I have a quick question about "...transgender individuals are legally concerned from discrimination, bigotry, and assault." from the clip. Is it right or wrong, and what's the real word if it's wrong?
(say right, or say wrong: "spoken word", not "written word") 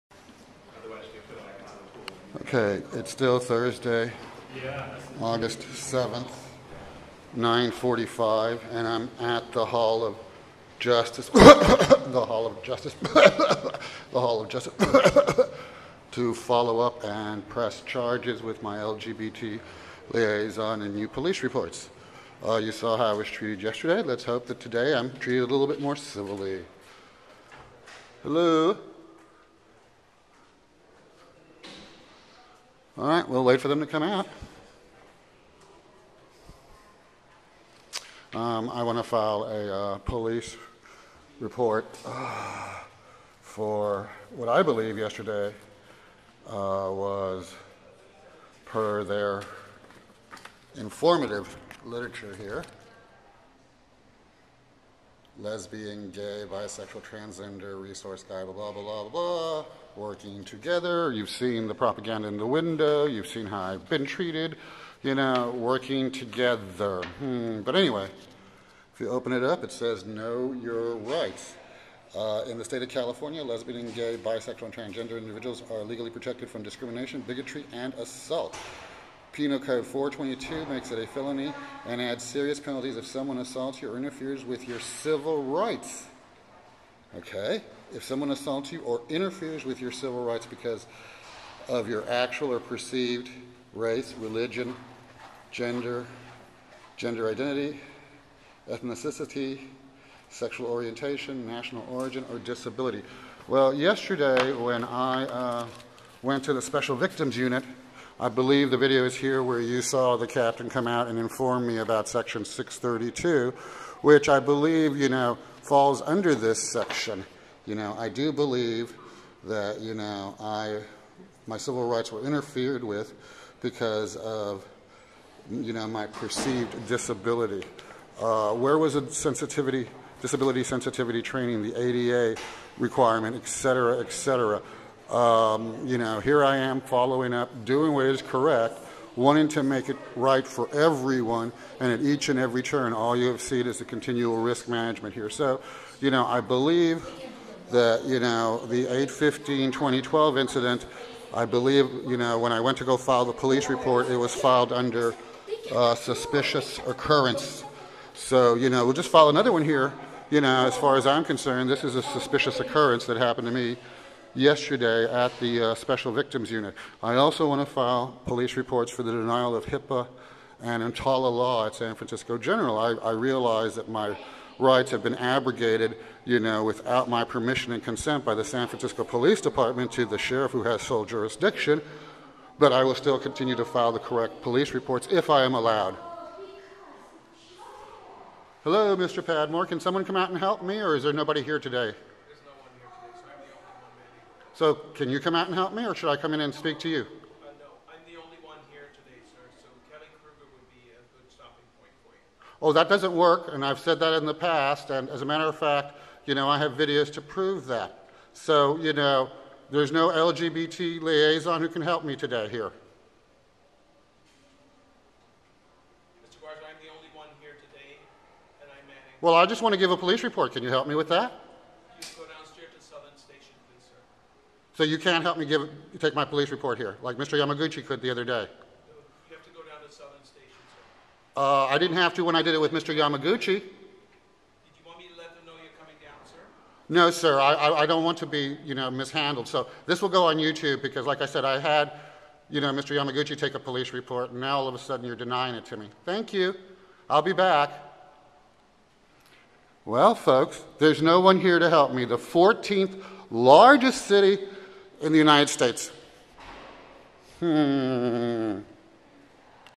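wrong: "protected", not "concerned".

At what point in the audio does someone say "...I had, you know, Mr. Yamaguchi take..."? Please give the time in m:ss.
4:01.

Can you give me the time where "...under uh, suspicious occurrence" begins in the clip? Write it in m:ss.
2:34.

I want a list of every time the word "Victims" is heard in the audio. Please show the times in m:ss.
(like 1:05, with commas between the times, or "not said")
1:46, 2:46.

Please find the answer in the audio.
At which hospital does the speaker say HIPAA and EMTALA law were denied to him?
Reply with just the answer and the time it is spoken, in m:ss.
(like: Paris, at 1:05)
San Francisco General, at 2:51.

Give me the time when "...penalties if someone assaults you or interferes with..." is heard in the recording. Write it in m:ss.
1:22.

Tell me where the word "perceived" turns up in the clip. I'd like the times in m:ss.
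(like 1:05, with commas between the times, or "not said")
1:32, 2:06.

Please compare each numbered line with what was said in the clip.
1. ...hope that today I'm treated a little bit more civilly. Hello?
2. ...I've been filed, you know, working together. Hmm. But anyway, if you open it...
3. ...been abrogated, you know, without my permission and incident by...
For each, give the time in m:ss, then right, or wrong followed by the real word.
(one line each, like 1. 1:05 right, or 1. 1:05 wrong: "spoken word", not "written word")
1. 0:24 right
2. 1:03 wrong: "treated", not "filed"
3. 2:55 wrong: "consent", not "incident".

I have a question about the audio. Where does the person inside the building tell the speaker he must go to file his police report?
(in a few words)
Southern Station.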